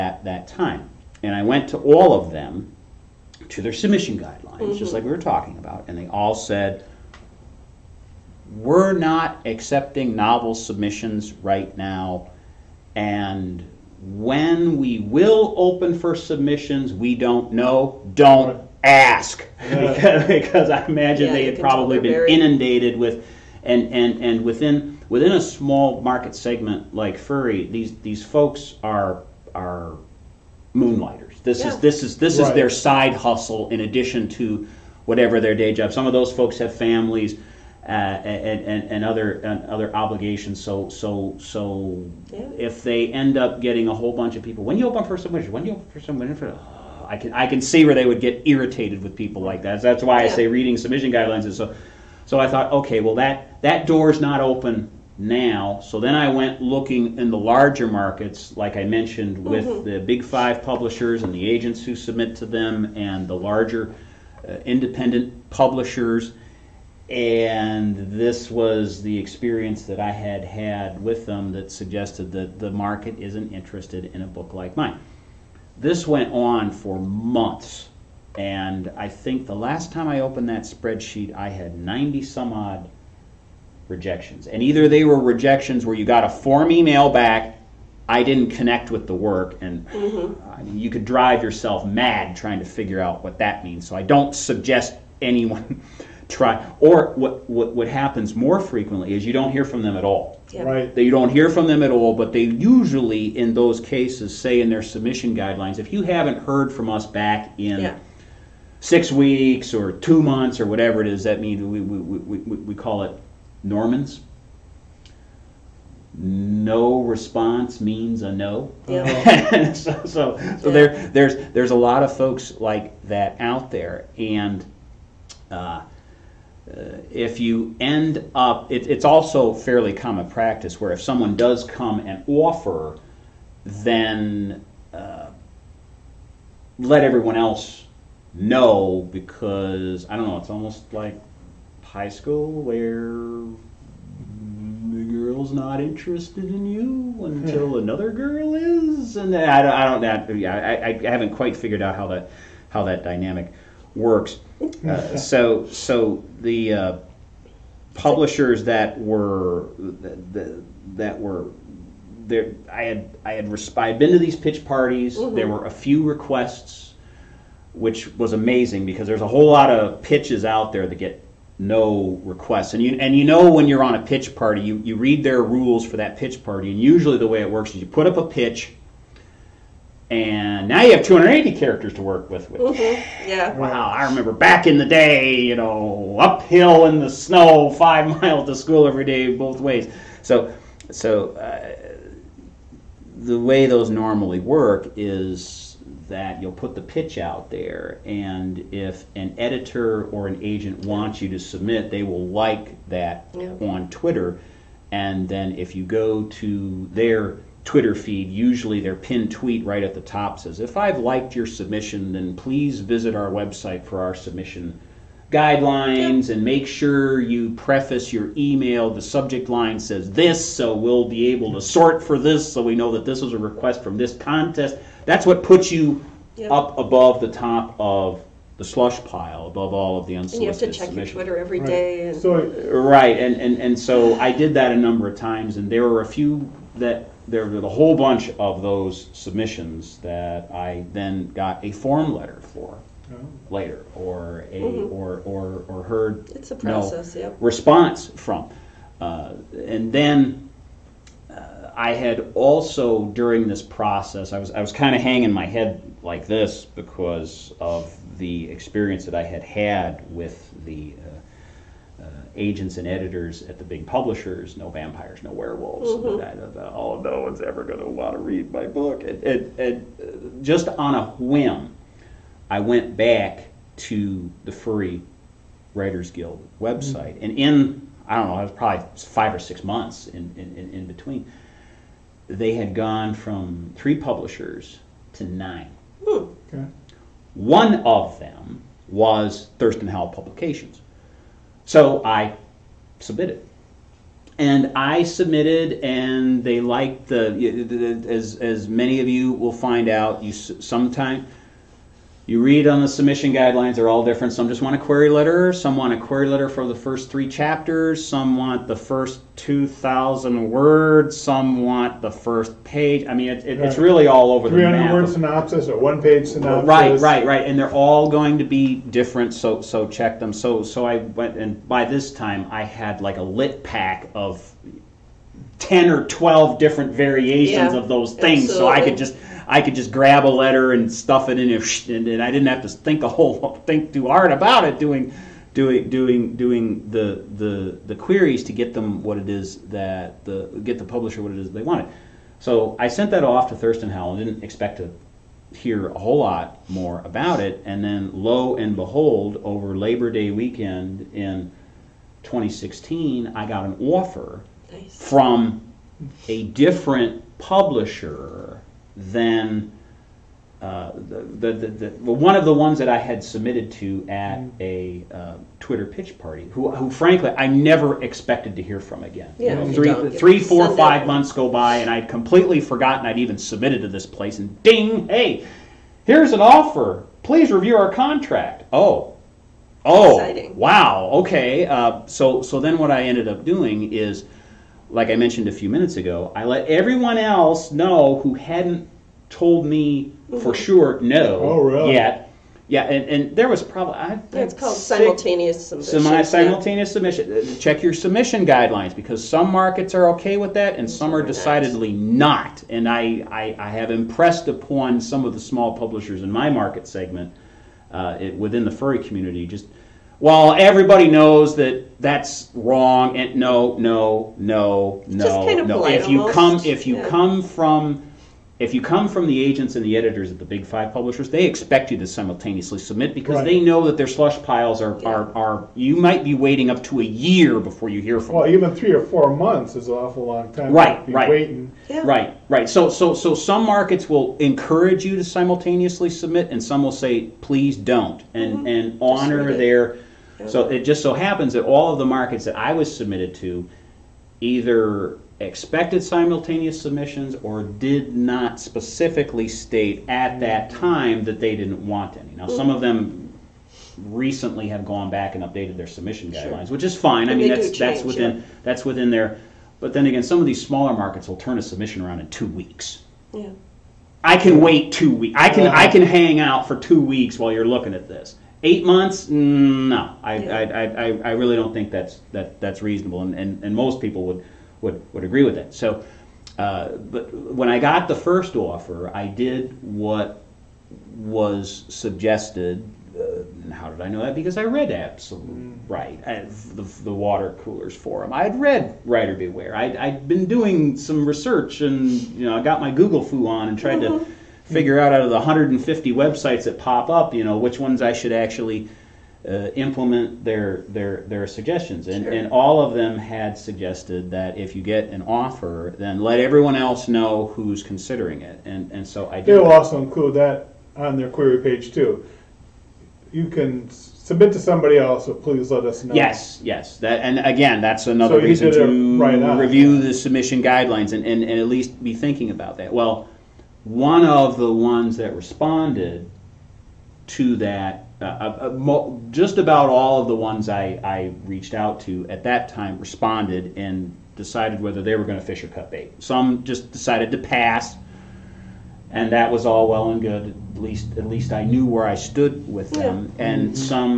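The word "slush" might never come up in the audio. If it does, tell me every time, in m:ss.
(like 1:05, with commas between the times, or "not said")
3:48, 7:04.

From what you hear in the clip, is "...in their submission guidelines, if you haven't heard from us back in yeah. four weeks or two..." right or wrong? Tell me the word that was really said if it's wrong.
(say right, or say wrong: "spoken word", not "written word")
wrong: "six", not "four".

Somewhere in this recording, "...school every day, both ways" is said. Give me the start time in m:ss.
3:08.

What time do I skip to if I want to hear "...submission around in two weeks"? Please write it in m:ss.
7:41.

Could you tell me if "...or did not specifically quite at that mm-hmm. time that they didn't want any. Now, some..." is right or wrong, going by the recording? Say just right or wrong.
wrong.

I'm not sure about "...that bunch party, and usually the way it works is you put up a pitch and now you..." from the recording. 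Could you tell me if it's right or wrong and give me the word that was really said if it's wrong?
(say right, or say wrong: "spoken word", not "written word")
wrong: "pitch", not "bunch".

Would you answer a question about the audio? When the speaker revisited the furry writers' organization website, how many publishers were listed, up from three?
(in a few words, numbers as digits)
nine.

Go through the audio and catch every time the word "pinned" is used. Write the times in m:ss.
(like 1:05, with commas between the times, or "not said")
3:28.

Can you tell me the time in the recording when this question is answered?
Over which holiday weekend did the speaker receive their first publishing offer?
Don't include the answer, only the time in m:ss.
5:49.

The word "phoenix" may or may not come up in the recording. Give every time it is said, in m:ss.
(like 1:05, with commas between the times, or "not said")
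not said.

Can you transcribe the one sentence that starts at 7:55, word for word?
So, uh, but when I got the first offer, I did what was suggested.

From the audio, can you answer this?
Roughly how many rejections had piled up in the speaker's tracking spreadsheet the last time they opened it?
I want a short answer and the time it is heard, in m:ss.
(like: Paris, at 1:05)
90 some odd, at 1:21.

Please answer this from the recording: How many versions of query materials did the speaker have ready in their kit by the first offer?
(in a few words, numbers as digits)
10 or 12.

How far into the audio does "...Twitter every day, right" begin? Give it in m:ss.
3:51.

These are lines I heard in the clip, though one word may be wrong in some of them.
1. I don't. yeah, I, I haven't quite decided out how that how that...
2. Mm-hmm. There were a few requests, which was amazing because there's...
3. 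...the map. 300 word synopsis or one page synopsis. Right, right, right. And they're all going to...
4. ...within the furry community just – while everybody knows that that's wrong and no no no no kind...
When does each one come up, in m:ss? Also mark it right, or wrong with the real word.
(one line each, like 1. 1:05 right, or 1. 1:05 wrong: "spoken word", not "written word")
1. 2:30 wrong: "figured", not "decided"
2. 2:45 right
3. 5:14 right
4. 6:48 right.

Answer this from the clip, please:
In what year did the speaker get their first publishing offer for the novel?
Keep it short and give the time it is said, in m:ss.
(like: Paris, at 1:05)
2016, at 5:52.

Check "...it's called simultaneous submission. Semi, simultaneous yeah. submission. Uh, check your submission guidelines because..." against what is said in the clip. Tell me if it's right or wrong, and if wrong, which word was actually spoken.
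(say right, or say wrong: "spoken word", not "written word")
right.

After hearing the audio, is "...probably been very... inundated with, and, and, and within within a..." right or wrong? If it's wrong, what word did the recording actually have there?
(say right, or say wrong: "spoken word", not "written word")
right.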